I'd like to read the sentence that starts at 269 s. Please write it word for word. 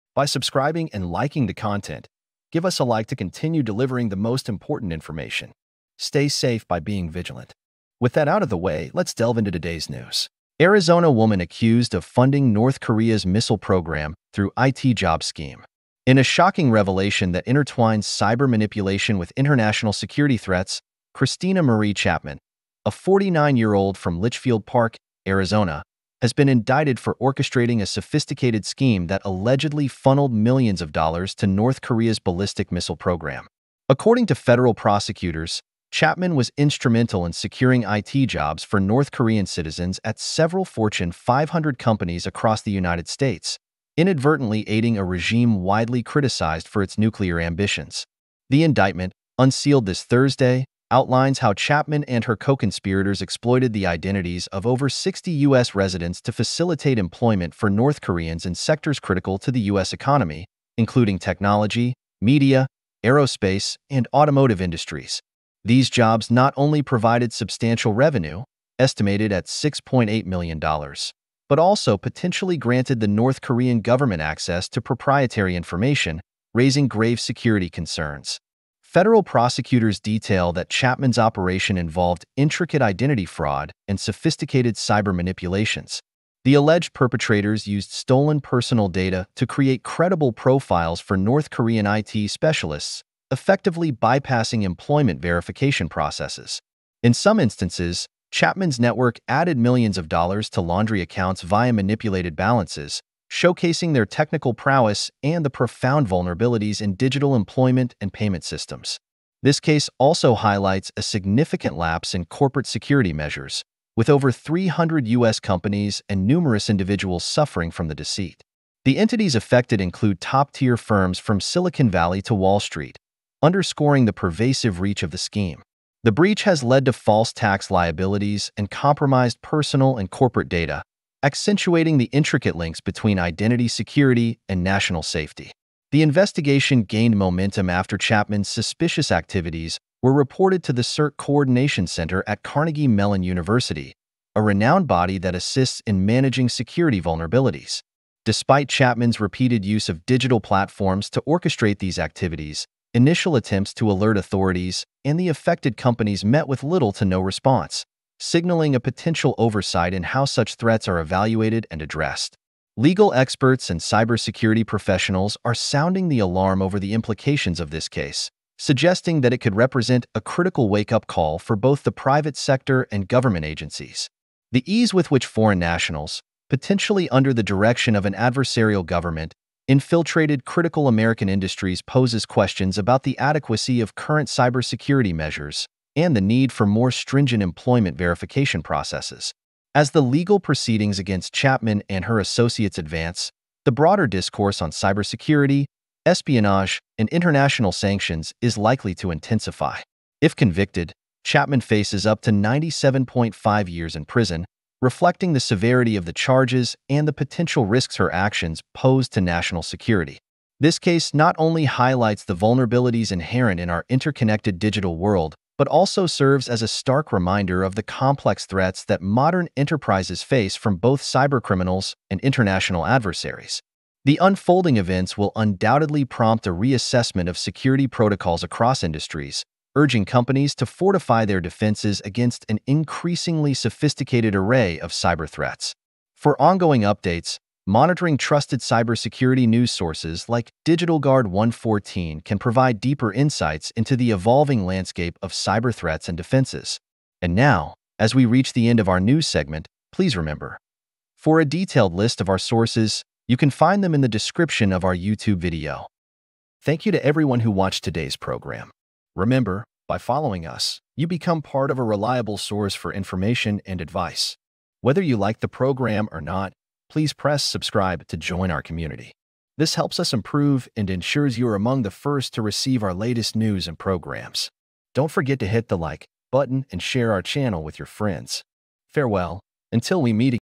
This helps us improve and ensures you are among the first to receive our latest news and programs.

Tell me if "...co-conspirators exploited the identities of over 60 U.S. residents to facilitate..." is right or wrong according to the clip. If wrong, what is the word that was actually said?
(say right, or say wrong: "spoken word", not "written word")
right.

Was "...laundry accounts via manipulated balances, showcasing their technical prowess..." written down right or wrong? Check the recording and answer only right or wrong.
right.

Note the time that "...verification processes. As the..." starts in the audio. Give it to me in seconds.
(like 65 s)
187 s.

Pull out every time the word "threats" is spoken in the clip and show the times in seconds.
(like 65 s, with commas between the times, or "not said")
20 s, 160 s, 218 s, 235 s, 245 s.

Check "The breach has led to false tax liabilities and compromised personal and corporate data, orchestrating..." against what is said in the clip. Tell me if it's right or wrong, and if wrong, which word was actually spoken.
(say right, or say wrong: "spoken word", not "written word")
wrong: "accentuating", not "orchestrating".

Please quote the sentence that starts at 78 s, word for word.
Federal prosecutors detail that Chapman's operation involved intricate identity fraud and sophisticated cyber manipulations.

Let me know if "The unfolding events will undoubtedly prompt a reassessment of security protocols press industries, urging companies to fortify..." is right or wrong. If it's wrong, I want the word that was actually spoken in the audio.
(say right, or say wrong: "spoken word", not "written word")
wrong: "across", not "press".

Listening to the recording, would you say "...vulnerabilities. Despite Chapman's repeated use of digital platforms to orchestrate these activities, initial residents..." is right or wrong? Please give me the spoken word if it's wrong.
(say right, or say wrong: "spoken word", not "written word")
wrong: "attempts", not "residents".